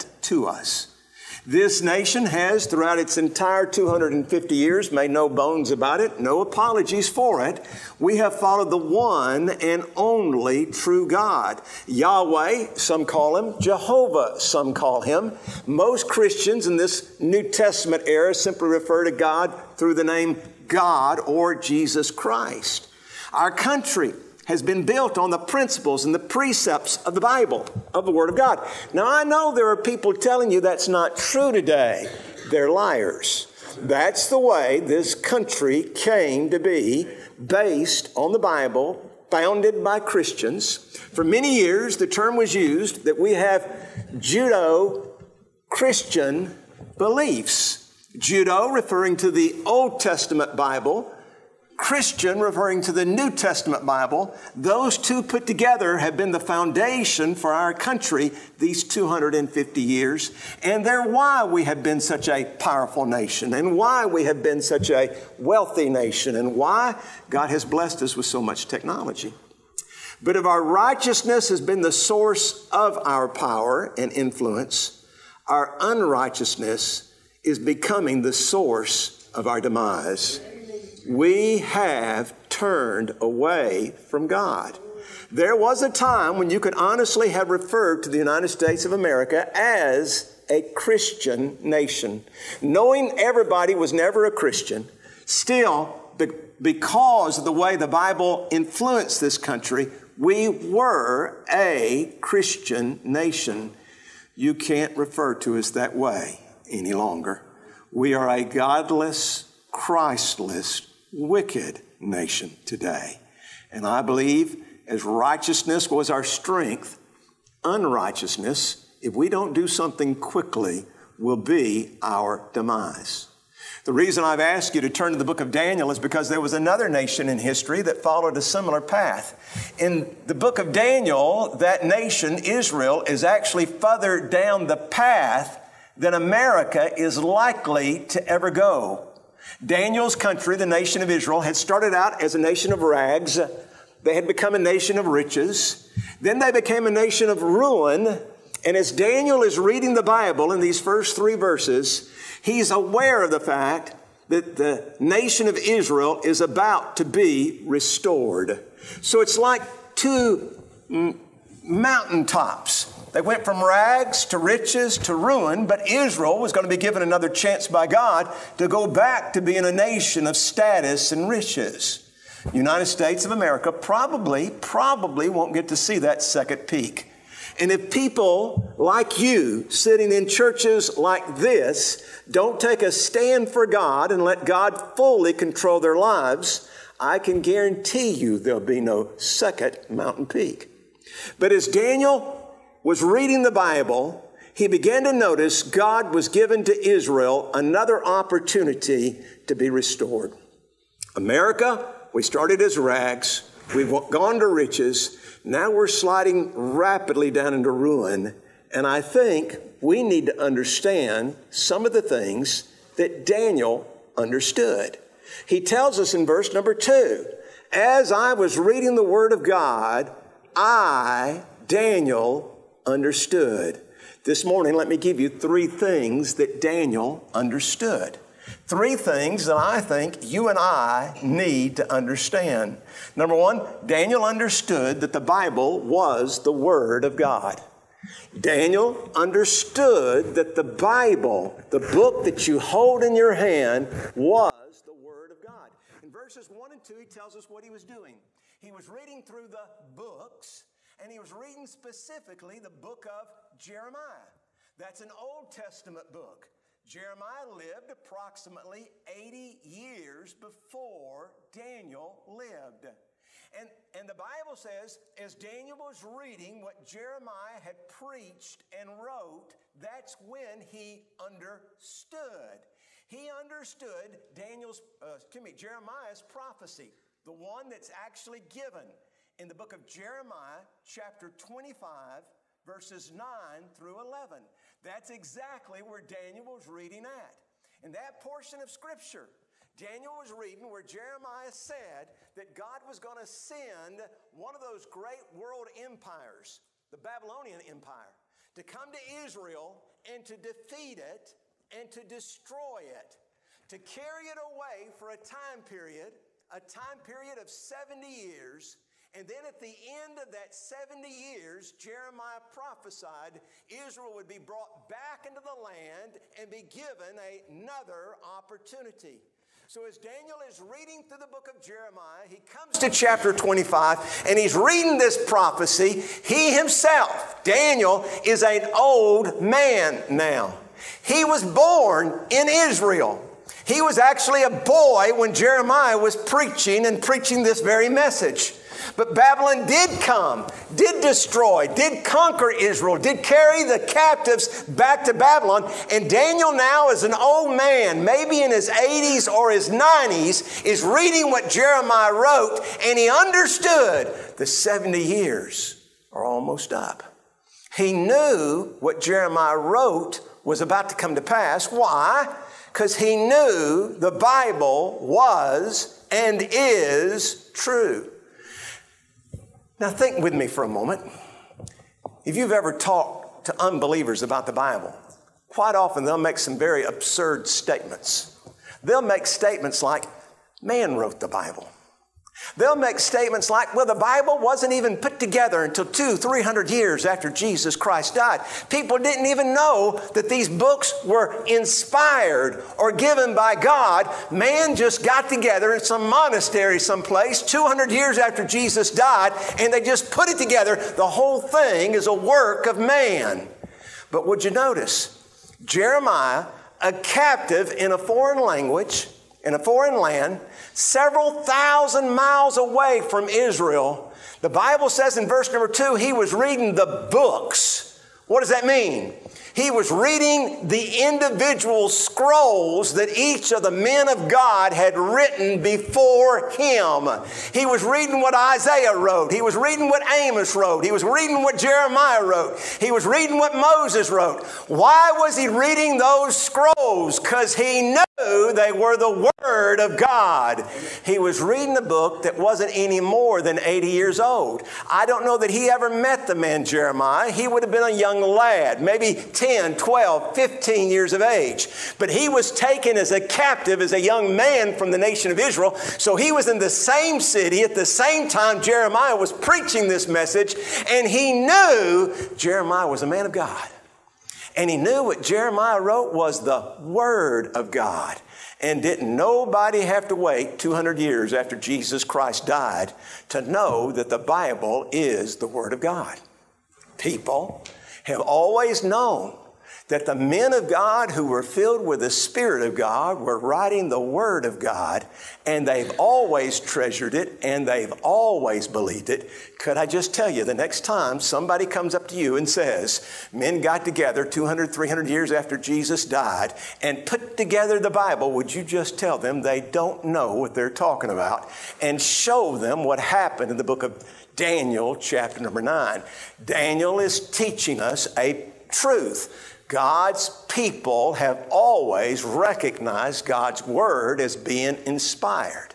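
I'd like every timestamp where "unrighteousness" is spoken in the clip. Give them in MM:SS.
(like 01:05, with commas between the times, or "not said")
01:15, 01:57.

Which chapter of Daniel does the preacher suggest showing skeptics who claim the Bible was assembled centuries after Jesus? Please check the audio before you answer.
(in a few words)
Chapter 9.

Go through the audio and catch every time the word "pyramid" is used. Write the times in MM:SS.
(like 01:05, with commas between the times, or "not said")
not said.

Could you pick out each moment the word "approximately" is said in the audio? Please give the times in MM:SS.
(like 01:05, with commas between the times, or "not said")
04:17.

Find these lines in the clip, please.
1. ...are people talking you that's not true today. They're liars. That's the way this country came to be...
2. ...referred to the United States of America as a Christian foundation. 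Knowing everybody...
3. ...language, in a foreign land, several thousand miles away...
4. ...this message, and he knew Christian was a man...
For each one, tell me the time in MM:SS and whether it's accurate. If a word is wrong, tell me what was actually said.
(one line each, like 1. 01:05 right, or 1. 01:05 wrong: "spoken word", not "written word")
1. 00:29 wrong: "telling", not "talking"
2. 01:27 wrong: "nation", not "foundation"
3. 06:48 right
4. 07:39 wrong: "Jeremiah", not "Christian".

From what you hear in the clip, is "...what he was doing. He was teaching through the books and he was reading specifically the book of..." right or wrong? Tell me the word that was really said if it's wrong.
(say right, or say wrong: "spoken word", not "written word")
wrong: "reading", not "teaching".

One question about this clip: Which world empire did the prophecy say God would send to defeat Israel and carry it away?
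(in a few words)
Babylonian Empire.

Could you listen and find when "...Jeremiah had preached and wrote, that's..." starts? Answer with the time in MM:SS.
04:26.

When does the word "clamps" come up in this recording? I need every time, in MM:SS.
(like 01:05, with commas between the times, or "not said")
not said.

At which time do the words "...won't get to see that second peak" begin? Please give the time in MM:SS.
02:55.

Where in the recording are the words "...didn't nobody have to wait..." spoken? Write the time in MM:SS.
07:48.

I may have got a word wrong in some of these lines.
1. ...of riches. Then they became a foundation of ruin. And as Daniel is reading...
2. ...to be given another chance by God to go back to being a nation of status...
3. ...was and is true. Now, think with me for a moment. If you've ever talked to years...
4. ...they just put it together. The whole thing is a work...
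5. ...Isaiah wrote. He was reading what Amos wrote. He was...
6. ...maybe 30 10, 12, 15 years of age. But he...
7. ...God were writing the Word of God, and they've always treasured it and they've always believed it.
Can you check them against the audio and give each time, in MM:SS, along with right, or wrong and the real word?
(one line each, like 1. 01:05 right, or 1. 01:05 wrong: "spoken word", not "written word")
1. 02:24 wrong: "nation", not "foundation"
2. 02:46 right
3. 06:05 wrong: "unbelievers", not "years"
4. 06:39 right
5. 07:08 right
6. 07:28 wrong: "10", not "30"
7. 08:02 right.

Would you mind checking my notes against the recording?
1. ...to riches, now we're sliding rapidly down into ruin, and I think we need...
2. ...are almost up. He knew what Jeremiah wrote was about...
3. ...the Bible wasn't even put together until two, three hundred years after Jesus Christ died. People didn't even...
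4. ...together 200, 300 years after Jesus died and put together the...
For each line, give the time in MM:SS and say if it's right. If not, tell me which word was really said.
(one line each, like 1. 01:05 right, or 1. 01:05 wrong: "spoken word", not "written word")
1. 03:24 right
2. 05:56 right
3. 06:23 right
4. 08:13 right.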